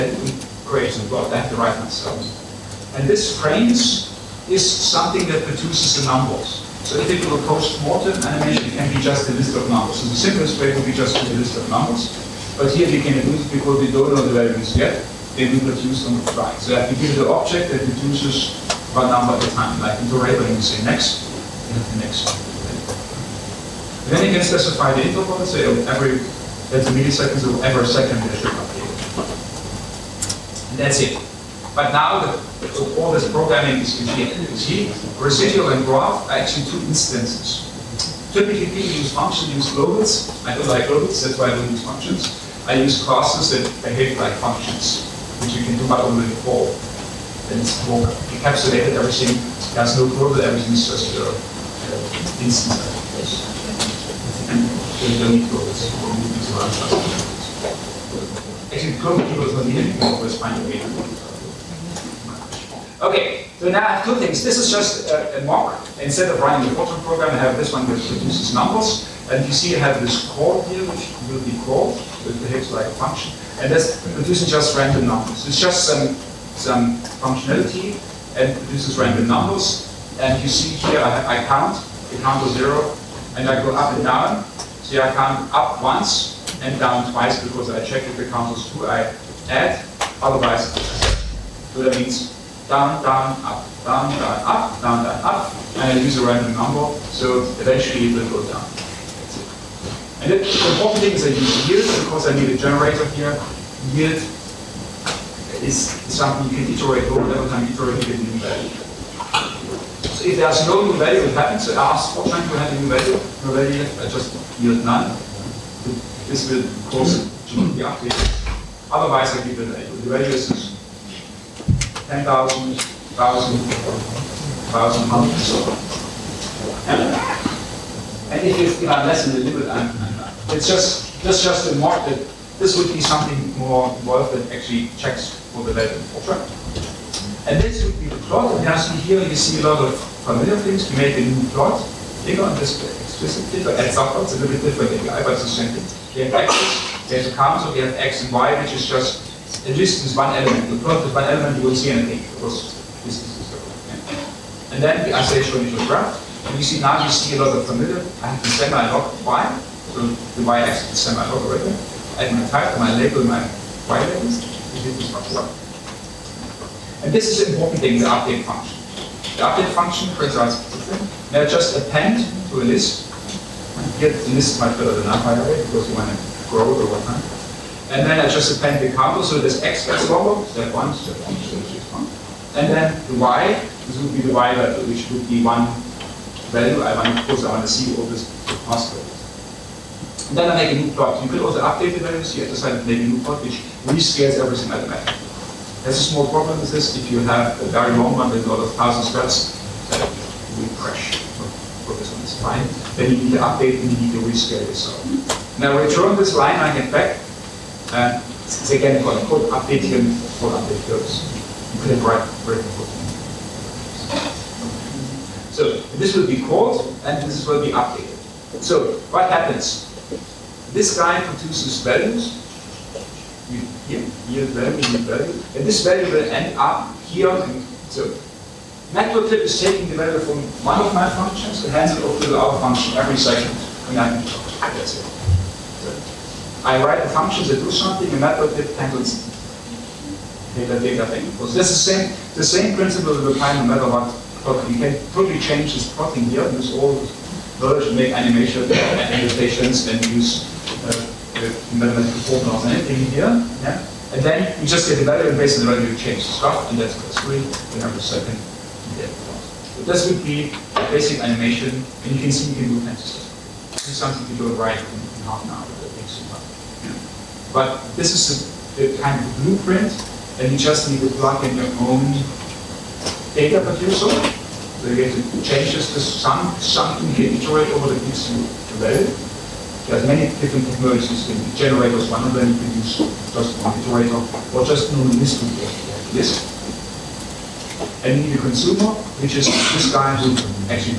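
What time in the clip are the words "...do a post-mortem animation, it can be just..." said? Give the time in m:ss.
0:07.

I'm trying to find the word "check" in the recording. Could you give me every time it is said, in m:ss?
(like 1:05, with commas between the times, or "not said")
1:27, 2:14.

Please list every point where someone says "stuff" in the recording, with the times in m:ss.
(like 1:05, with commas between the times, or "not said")
4:16, 4:23.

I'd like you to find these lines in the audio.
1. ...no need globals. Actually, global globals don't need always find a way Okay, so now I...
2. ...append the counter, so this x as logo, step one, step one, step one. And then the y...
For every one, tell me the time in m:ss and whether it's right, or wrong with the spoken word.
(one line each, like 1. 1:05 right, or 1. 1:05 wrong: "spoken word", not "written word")
1. 0:55 right
2. 2:58 right.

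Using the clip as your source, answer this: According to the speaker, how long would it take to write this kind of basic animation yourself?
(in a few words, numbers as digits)
half an hour.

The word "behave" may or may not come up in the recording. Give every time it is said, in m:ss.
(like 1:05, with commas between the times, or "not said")
0:43, 1:12.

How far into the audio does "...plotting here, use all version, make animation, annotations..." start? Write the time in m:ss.
4:05.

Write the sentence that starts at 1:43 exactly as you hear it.
Yield is something you can iterate over every time you iterate you get a new value.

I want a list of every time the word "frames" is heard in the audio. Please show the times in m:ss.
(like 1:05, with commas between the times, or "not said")
0:03.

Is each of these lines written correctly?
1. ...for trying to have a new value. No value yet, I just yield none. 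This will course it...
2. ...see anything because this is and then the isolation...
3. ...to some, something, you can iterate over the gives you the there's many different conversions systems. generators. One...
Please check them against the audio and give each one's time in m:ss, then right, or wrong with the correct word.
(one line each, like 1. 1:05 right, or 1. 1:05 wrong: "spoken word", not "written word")
1. 1:52 wrong: "cause", not "course"
2. 2:31 right
3. 4:35 right.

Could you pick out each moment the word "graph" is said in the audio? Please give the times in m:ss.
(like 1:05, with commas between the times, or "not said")
0:35, 2:35.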